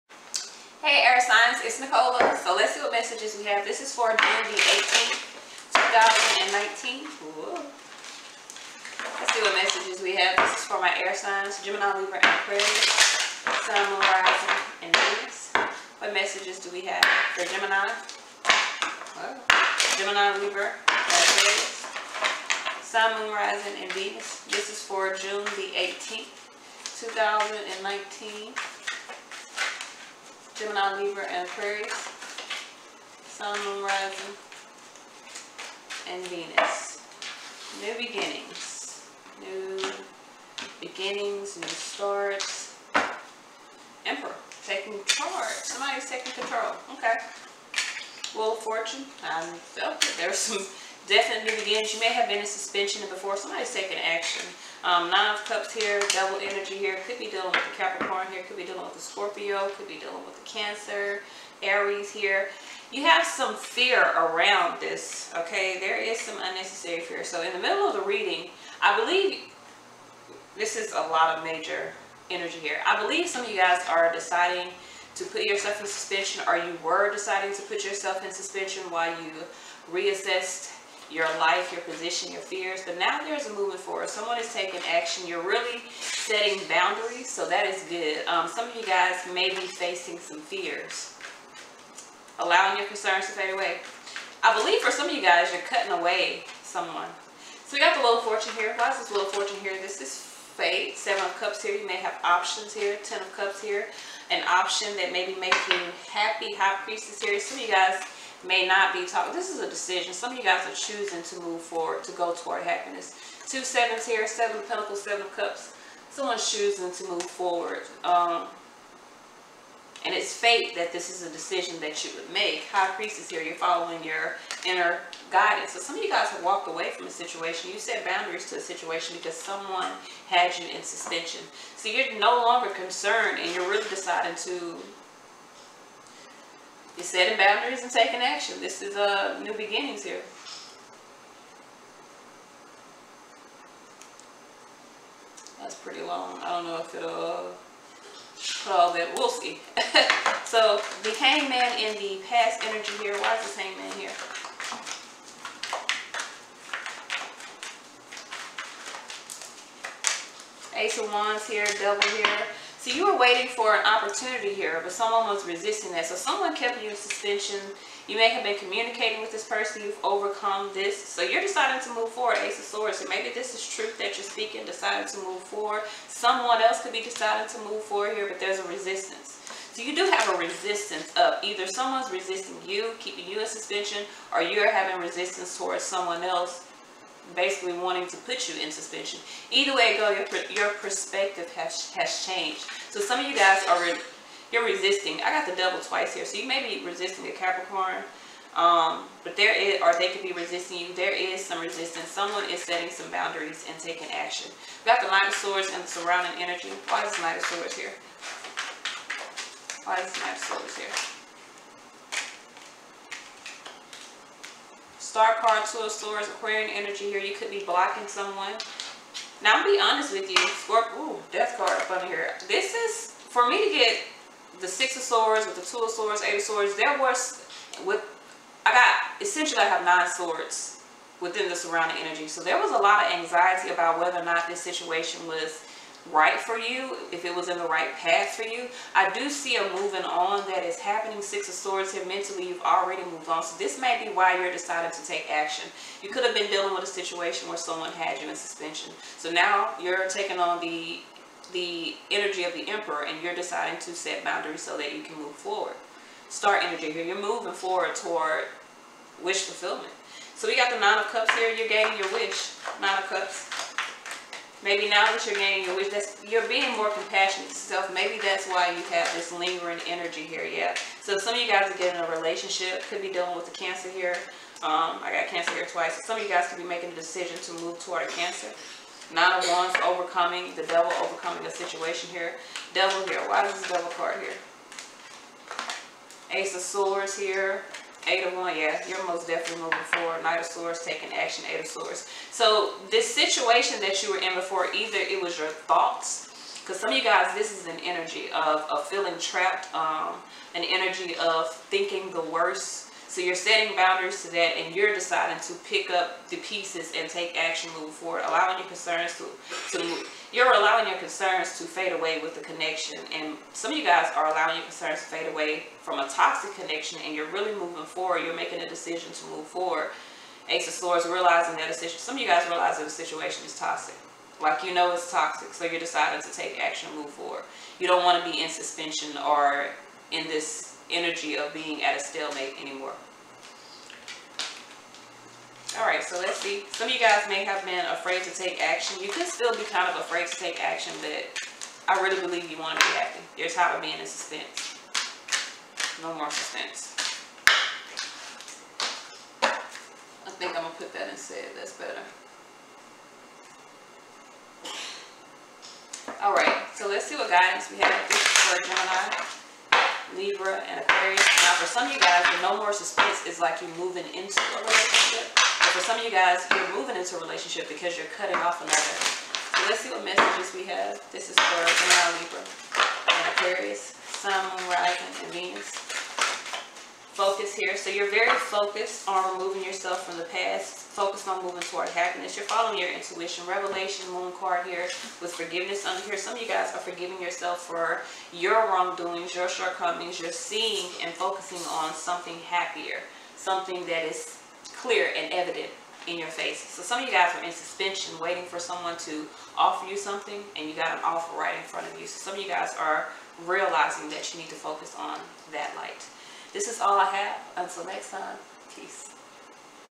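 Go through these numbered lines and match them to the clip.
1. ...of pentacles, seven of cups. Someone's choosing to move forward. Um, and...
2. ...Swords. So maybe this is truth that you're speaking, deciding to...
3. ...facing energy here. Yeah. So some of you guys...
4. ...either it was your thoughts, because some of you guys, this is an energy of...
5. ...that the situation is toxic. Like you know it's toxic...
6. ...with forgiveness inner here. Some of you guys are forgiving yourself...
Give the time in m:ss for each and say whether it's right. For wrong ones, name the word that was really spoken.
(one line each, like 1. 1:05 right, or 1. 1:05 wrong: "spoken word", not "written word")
1. 1:54 right
2. 2:52 right
3. 4:29 wrong: "lingering", not "facing"
4. 4:54 right
5. 5:22 right
6. 6:25 wrong: "under", not "inner".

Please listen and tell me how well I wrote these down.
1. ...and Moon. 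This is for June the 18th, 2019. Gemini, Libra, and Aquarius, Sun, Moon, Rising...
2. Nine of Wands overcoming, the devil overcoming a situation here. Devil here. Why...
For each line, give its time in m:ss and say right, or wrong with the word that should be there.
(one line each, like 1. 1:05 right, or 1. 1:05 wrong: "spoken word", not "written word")
1. 0:23 wrong: "Venus", not "Moon"
2. 4:39 right.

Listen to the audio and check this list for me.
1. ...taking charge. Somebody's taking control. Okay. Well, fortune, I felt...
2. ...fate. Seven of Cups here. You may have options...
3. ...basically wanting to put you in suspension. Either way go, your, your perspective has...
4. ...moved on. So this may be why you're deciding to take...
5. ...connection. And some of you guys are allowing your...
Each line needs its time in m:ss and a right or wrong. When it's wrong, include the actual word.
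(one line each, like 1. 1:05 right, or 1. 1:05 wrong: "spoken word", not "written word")
1. 0:44 right
2. 1:40 right
3. 3:07 right
4. 4:03 right
5. 5:12 right.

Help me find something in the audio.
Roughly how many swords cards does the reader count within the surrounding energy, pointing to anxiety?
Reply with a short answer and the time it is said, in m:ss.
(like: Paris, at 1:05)
9, at 3:49.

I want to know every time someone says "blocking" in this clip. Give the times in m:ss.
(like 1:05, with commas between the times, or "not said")
3:37.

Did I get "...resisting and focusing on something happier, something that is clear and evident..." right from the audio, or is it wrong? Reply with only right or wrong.
wrong.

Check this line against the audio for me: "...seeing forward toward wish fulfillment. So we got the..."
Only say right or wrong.
wrong.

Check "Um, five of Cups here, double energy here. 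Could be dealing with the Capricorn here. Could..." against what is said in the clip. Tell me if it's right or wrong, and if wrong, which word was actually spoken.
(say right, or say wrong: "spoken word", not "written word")
wrong: "nine", not "five".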